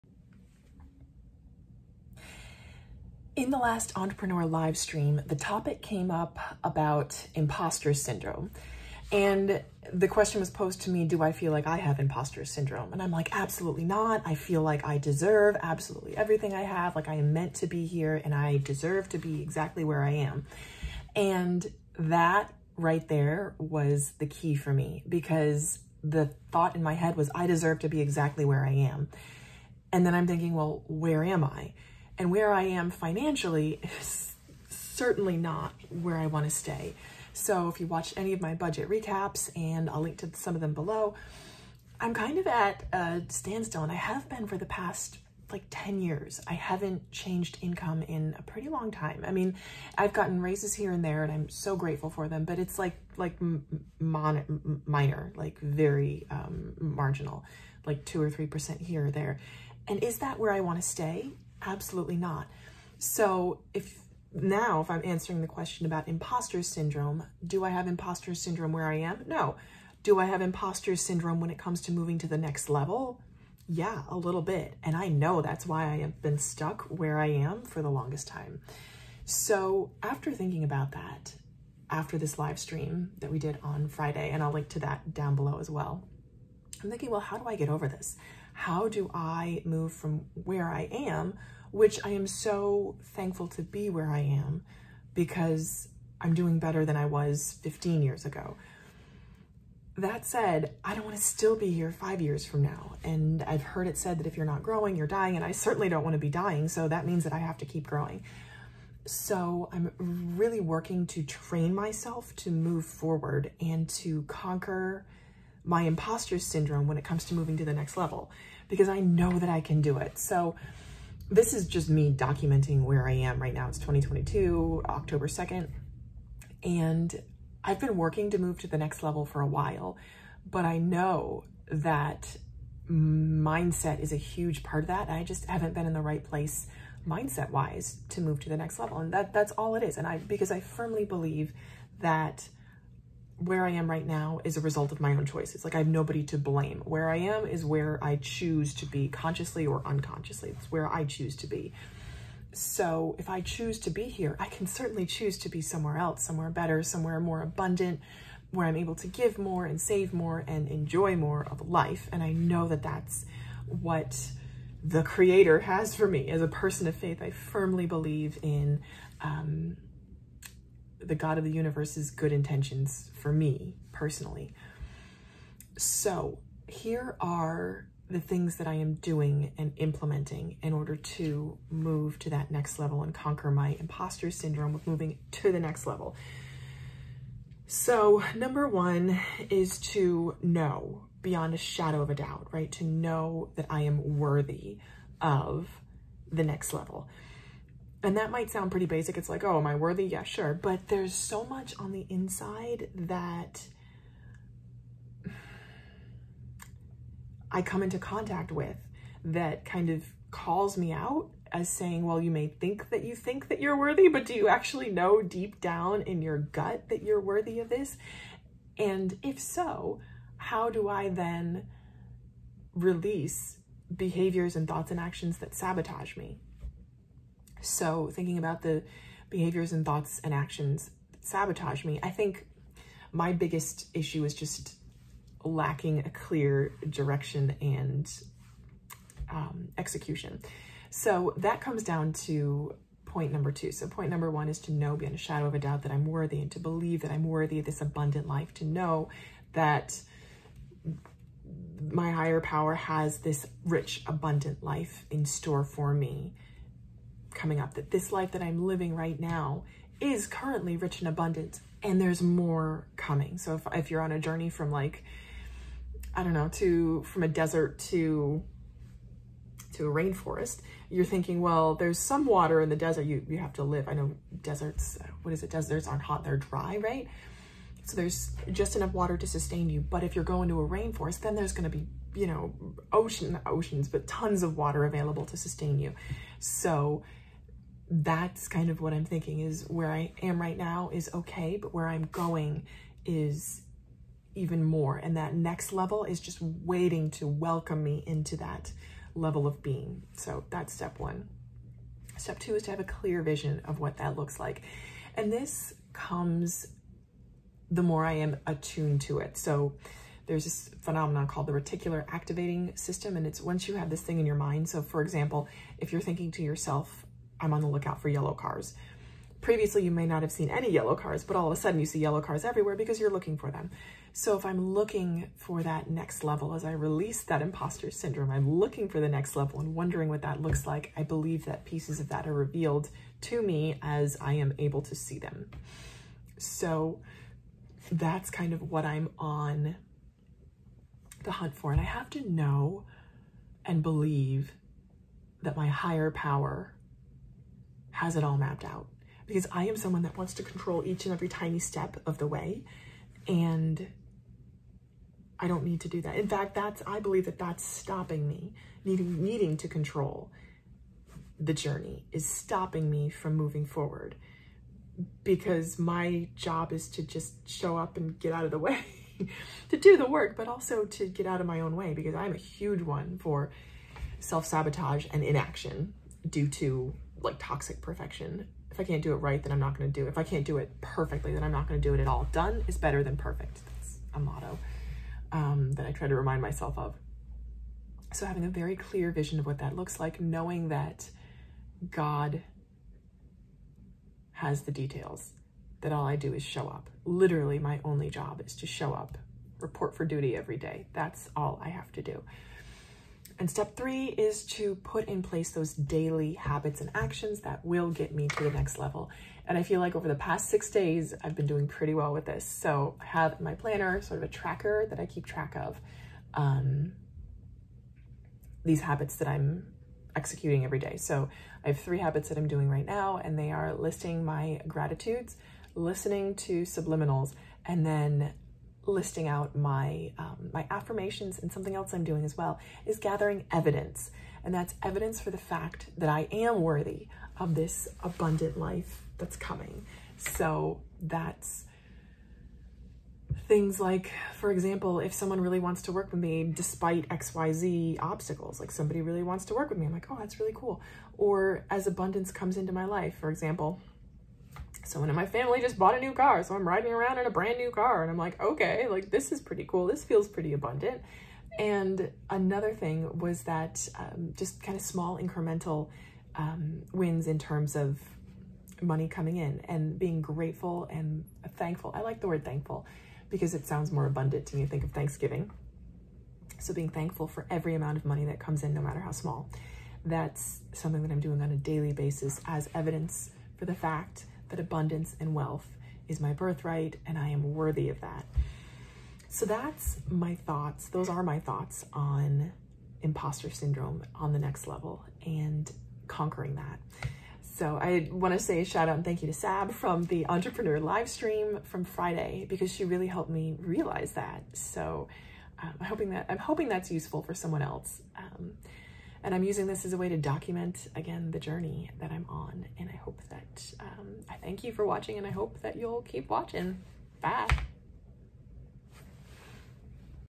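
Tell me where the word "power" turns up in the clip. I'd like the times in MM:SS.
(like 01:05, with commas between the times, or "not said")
04:12, 05:46.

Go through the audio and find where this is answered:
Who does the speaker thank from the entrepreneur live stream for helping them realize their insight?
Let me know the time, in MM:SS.
08:19.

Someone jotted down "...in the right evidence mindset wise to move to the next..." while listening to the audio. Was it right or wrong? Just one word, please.
wrong.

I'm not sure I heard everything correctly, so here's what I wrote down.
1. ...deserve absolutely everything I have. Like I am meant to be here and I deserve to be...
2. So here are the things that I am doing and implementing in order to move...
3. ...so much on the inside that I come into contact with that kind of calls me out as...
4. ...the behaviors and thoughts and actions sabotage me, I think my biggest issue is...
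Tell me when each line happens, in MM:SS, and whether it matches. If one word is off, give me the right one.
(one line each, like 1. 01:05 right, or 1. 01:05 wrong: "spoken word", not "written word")
1. 00:14 right
2. 02:55 right
3. 03:21 right
4. 03:48 right.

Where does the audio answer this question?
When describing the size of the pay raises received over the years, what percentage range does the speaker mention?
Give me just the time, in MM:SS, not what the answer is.
00:58.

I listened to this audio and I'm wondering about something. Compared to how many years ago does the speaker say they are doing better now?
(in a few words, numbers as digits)
15 years.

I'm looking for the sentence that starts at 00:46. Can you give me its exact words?
I haven't changed income in a pretty long time.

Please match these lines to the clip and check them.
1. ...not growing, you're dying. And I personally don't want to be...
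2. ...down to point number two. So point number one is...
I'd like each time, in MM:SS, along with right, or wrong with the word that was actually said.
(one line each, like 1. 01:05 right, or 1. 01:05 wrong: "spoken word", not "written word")
1. 01:44 wrong: "certainly", not "personally"
2. 04:01 right.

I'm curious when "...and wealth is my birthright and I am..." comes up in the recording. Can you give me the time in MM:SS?
08:05.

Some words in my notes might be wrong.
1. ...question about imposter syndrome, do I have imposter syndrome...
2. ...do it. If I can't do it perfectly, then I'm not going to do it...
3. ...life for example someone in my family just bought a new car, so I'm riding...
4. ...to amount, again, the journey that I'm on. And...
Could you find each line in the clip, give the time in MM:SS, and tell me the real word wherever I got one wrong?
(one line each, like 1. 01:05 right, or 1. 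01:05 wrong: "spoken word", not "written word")
1. 01:05 right
2. 06:19 right
3. 07:32 right
4. 08:30 wrong: "document", not "amount".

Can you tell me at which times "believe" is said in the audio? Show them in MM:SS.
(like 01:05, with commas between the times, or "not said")
02:21, 02:47, 04:06, 05:31, 05:43, 05:56.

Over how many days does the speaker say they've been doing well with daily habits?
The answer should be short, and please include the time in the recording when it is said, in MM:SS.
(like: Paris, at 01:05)
six days, at 06:50.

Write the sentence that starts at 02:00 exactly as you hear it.
So this is just me documenting where I am right now.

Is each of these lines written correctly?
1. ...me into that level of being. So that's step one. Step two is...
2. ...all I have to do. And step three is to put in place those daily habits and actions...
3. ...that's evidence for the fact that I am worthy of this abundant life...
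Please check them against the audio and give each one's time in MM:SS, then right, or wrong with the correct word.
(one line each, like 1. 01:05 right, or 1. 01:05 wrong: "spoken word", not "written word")
1. 04:57 right
2. 06:41 right
3. 07:14 right.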